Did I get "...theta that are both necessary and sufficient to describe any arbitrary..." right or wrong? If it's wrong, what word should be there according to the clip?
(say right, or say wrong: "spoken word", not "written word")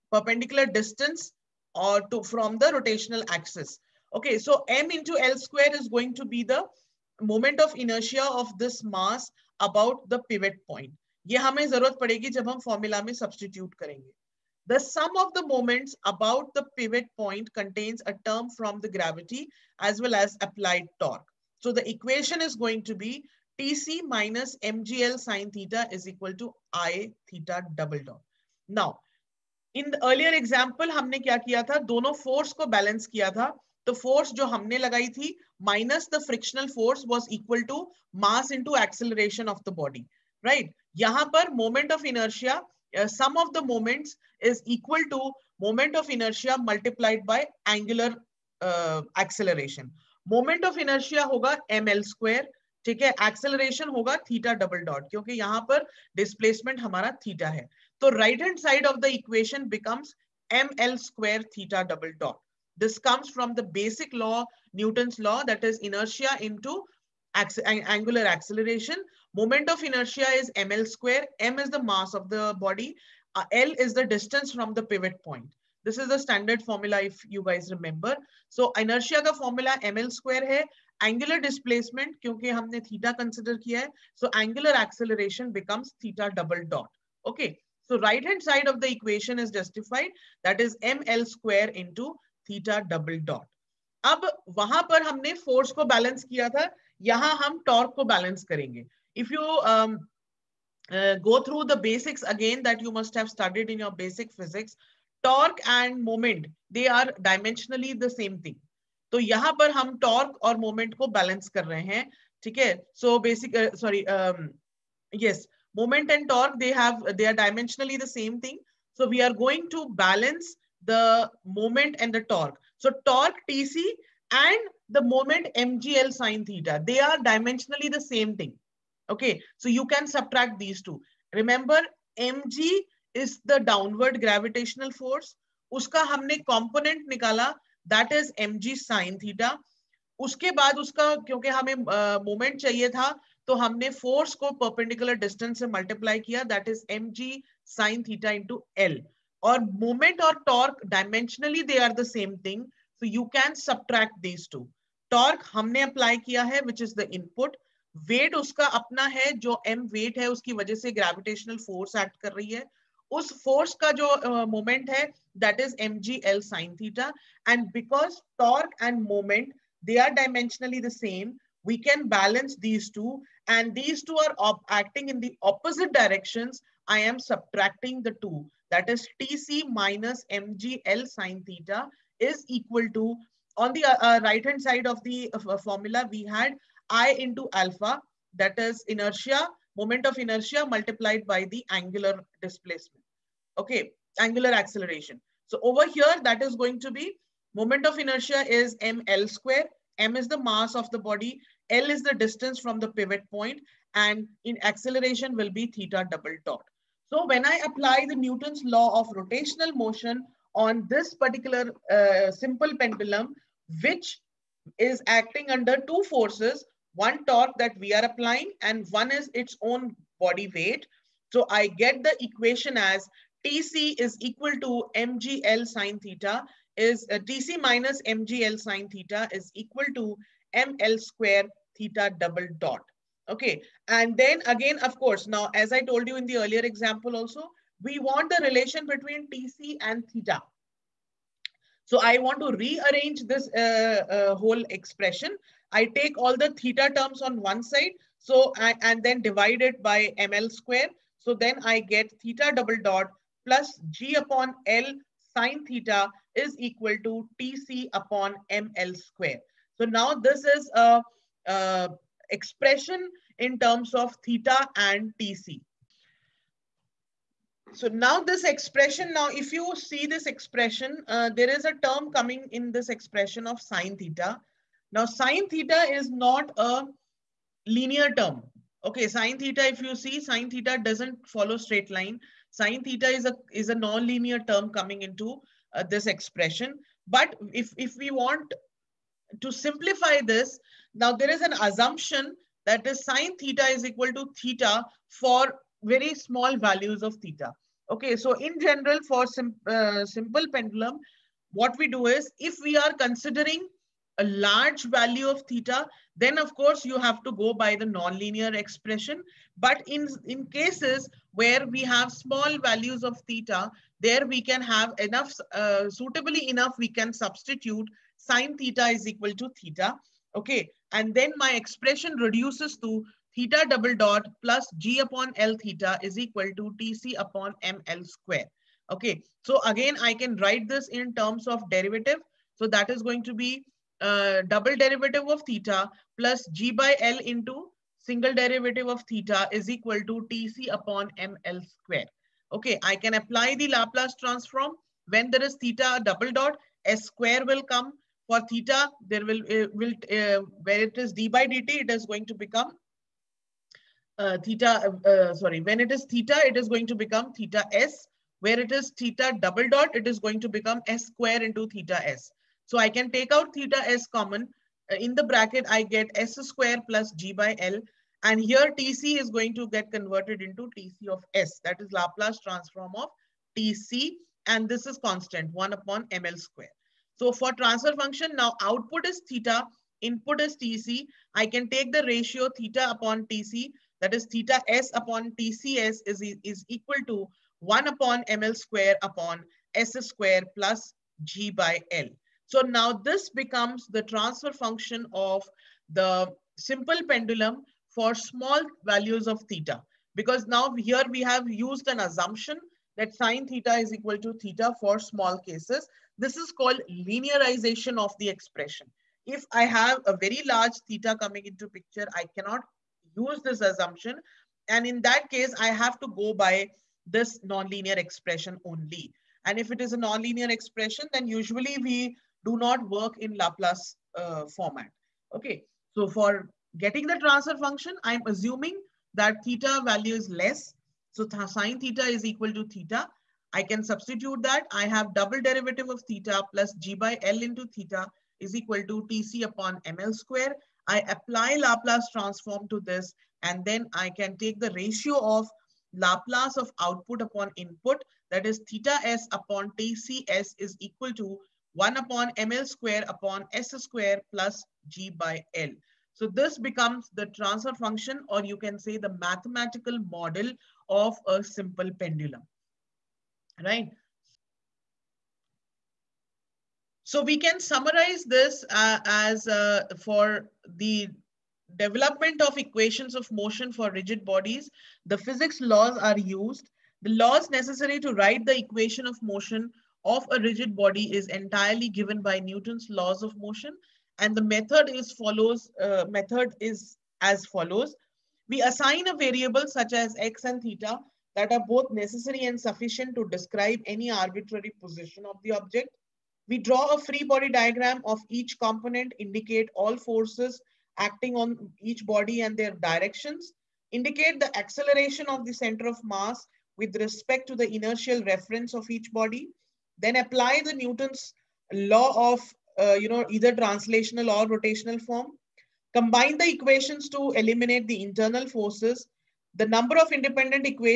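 right.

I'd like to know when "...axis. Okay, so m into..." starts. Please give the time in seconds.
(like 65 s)
3 s.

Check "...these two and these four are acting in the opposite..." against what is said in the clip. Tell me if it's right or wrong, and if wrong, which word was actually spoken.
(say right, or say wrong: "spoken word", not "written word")
wrong: "two", not "four".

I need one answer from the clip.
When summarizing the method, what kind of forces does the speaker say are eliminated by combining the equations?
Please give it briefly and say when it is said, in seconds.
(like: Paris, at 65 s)
internal forces, at 518 s.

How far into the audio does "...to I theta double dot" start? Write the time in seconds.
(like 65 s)
26 s.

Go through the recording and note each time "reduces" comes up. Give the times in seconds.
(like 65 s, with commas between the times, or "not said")
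322 s.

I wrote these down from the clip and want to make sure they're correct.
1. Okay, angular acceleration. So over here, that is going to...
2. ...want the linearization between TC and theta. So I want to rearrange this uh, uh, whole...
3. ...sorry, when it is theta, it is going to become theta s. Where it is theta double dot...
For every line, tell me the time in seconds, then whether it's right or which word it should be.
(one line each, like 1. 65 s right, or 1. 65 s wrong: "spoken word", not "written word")
1. 193 s right
2. 237 s wrong: "relation", not "linearization"
3. 355 s right.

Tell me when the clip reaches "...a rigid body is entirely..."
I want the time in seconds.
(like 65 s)
480 s.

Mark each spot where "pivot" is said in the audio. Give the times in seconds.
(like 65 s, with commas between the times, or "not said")
10 s, 16 s, 74 s, 202 s.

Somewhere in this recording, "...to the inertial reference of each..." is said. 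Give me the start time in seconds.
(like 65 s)
507 s.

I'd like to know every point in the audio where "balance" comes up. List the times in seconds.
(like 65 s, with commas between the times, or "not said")
32 s, 172 s.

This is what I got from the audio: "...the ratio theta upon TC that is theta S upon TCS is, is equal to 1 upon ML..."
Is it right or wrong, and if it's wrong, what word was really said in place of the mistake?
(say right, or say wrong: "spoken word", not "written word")
right.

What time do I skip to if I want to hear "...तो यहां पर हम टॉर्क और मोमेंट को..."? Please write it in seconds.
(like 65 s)
109 s.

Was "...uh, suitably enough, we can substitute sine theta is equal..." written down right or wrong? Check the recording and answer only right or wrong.
right.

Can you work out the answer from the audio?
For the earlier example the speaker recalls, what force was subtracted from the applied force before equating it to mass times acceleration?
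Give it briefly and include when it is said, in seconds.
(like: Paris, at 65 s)
frictional force, at 36 s.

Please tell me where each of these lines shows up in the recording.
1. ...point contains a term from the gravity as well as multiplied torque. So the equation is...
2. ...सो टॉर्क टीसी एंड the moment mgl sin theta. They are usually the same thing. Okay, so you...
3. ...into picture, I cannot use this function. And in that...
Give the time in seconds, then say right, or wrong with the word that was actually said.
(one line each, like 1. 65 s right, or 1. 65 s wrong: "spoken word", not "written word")
1. 17 s wrong: "applied", not "multiplied"
2. 122 s wrong: "dimensionally", not "usually"
3. 411 s wrong: "assumption", not "function".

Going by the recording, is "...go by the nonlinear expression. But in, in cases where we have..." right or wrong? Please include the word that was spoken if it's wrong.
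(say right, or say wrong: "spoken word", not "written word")
right.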